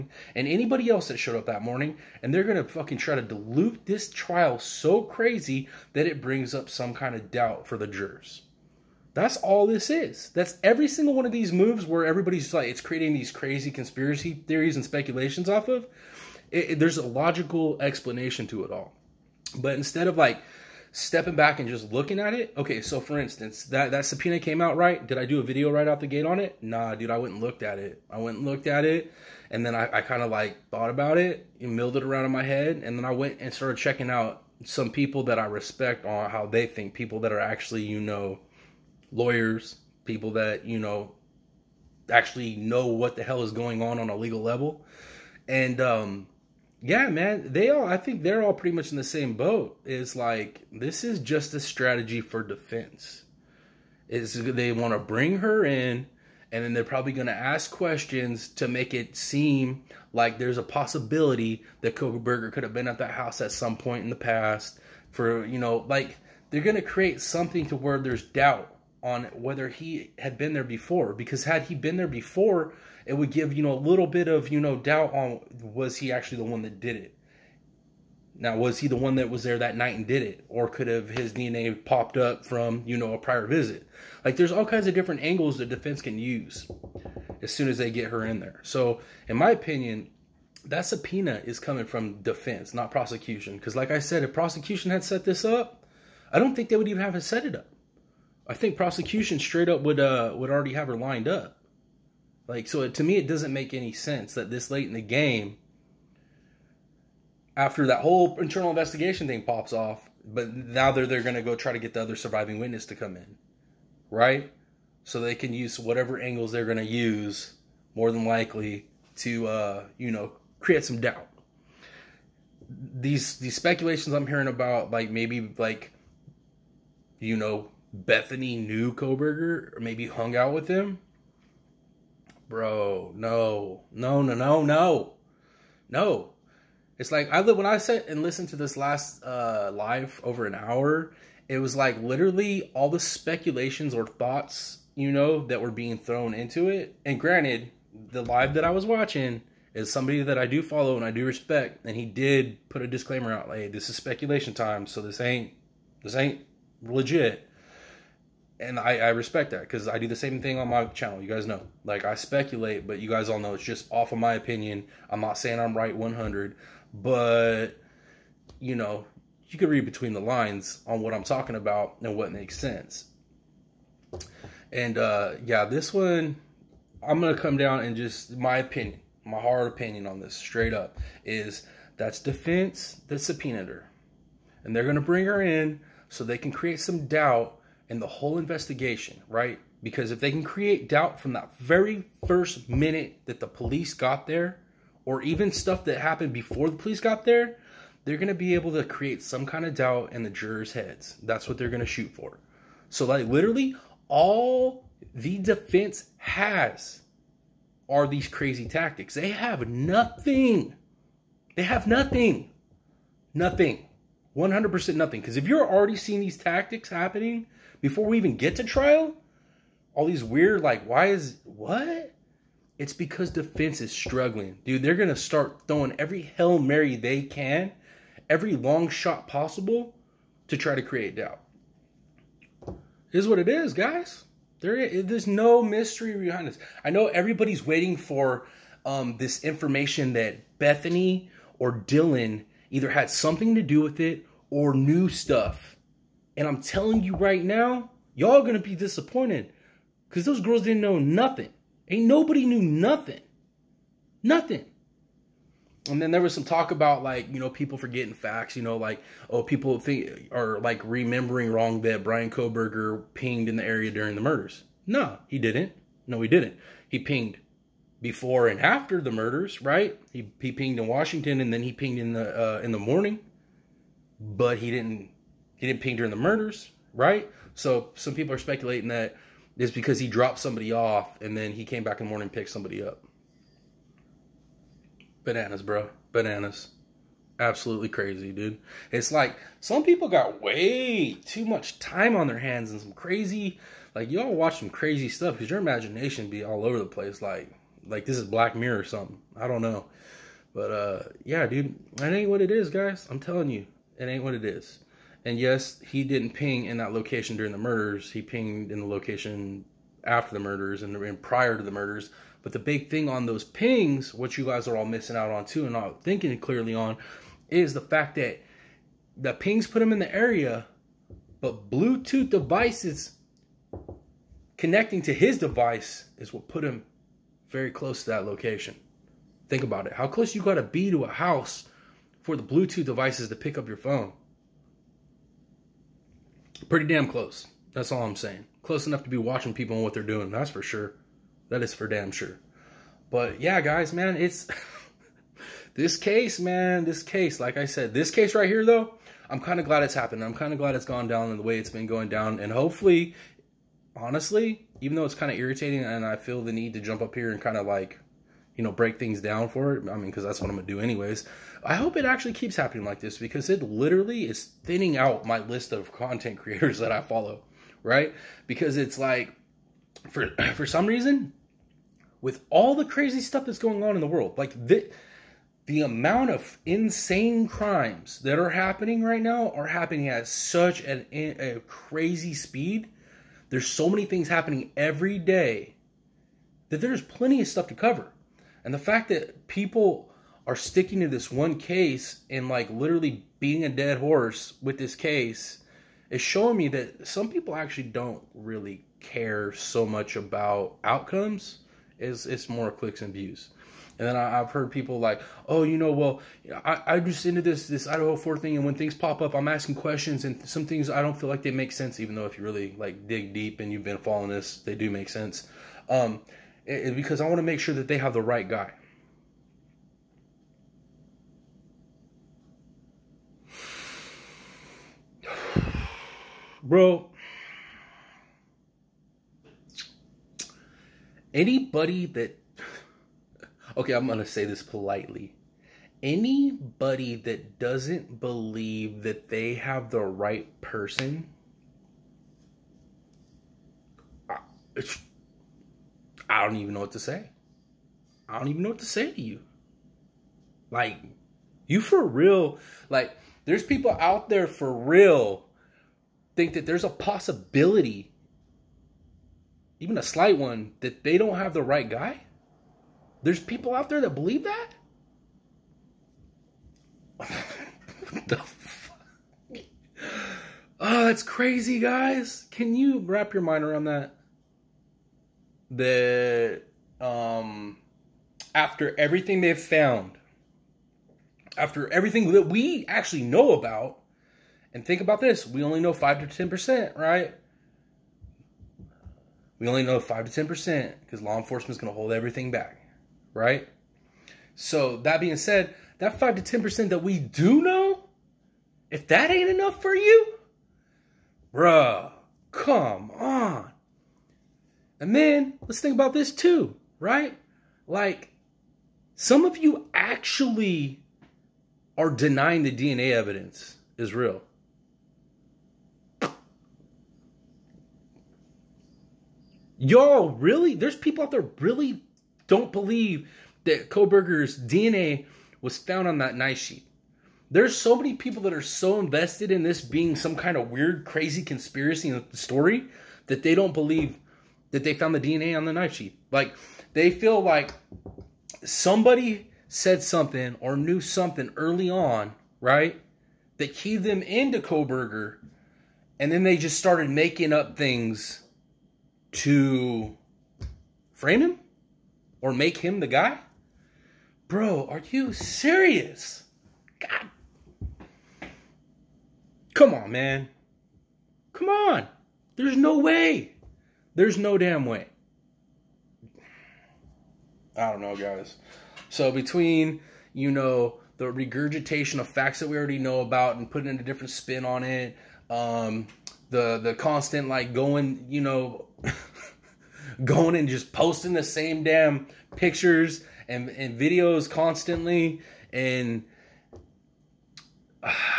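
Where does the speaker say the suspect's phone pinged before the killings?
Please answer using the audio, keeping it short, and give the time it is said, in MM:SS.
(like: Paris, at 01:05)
Washington, at 04:30.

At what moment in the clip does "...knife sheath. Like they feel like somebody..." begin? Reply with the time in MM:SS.
08:55.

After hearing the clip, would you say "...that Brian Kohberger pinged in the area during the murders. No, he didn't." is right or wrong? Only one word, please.
right.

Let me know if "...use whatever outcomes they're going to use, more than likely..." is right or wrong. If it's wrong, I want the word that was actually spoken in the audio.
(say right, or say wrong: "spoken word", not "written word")
wrong: "angles", not "outcomes".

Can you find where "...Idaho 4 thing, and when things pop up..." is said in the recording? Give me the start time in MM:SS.
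06:47.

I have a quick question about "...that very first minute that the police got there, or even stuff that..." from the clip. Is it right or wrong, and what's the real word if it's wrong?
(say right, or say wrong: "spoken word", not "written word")
right.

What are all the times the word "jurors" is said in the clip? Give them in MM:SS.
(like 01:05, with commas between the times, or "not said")
00:07, 03:20.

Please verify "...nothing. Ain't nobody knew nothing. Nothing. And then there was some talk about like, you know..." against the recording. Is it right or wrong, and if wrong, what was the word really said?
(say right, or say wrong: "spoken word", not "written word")
right.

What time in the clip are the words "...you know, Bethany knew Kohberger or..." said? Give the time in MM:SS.
02:07.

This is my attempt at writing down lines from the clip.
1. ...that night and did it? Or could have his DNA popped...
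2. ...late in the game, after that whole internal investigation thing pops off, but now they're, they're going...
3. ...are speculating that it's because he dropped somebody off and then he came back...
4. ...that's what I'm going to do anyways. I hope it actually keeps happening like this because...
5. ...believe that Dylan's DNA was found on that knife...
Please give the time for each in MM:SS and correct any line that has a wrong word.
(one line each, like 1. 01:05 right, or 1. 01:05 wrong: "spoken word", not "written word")
1. 01:19 right
2. 01:44 right
3. 04:38 right
4. 06:00 right
5. 08:42 wrong: "Kohberger", not "Dylan".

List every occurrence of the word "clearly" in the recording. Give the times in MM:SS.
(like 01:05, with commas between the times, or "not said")
05:16.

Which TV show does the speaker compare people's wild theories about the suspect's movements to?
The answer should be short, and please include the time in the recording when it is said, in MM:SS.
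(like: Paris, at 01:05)
Black Mirror, at 04:58.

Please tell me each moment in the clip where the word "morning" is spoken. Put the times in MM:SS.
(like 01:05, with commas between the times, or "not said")
00:01, 04:32, 04:42.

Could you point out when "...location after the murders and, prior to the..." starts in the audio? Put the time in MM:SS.
05:08.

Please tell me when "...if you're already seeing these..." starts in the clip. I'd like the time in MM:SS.
03:35.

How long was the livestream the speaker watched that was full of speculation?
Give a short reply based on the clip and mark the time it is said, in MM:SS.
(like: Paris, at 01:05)
Over an hour, at 02:20.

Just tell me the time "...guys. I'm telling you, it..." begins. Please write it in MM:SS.
05:02.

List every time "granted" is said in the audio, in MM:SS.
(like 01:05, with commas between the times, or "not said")
02:27.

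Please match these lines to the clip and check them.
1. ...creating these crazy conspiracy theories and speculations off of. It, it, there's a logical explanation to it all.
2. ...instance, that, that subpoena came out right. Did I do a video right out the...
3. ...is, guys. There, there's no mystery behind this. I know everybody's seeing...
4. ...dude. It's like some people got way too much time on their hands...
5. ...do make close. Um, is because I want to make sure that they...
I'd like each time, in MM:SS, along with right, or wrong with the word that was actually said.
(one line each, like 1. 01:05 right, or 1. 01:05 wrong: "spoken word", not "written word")
1. 00:12 right
2. 00:23 right
3. 03:53 wrong: "waiting", not "seeing"
4. 04:48 right
5. 06:54 wrong: "sense", not "close".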